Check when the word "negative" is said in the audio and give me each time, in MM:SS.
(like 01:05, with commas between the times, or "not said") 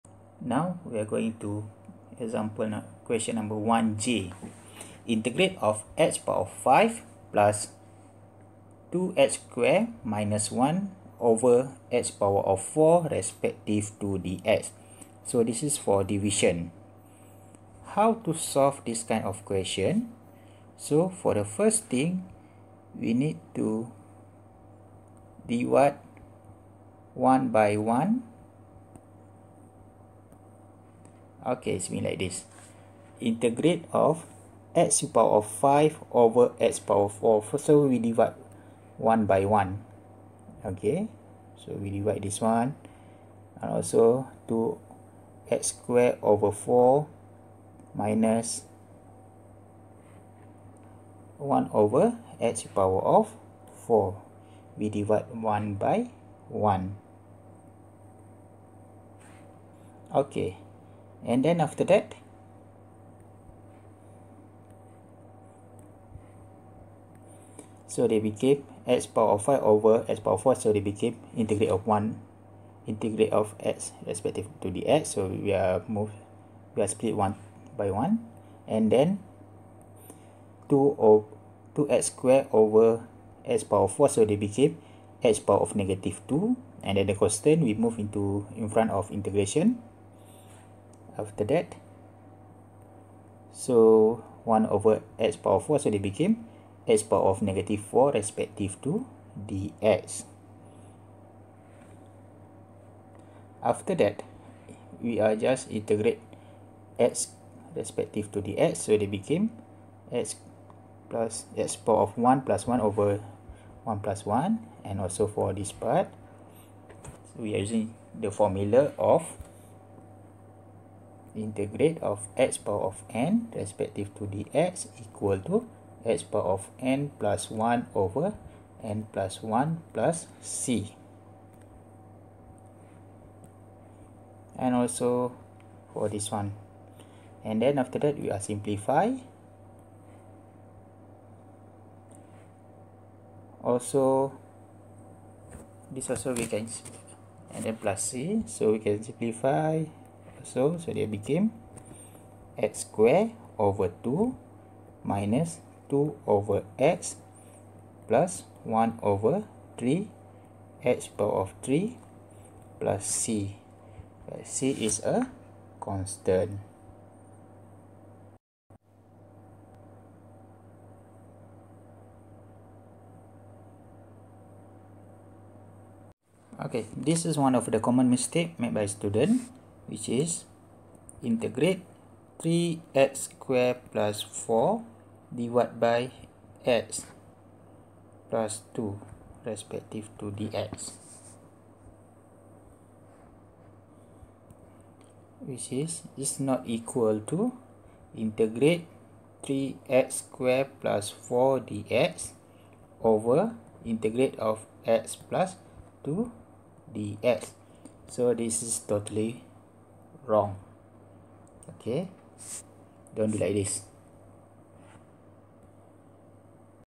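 01:25, 01:37.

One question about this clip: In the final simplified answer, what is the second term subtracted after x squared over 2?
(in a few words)
2 over x.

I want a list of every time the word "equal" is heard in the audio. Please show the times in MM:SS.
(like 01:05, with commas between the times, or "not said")
02:04, 03:16.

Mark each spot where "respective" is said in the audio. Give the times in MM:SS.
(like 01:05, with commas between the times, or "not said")
00:13, 01:14, 01:38, 01:47, 02:03, 03:09.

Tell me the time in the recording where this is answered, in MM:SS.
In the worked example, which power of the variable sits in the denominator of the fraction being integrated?
00:11.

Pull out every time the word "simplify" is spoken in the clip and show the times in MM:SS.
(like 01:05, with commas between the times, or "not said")
02:18, 02:29.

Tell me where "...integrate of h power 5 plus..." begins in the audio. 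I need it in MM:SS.
00:05.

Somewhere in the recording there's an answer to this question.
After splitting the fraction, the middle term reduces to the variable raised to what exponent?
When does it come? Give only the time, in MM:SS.
01:25.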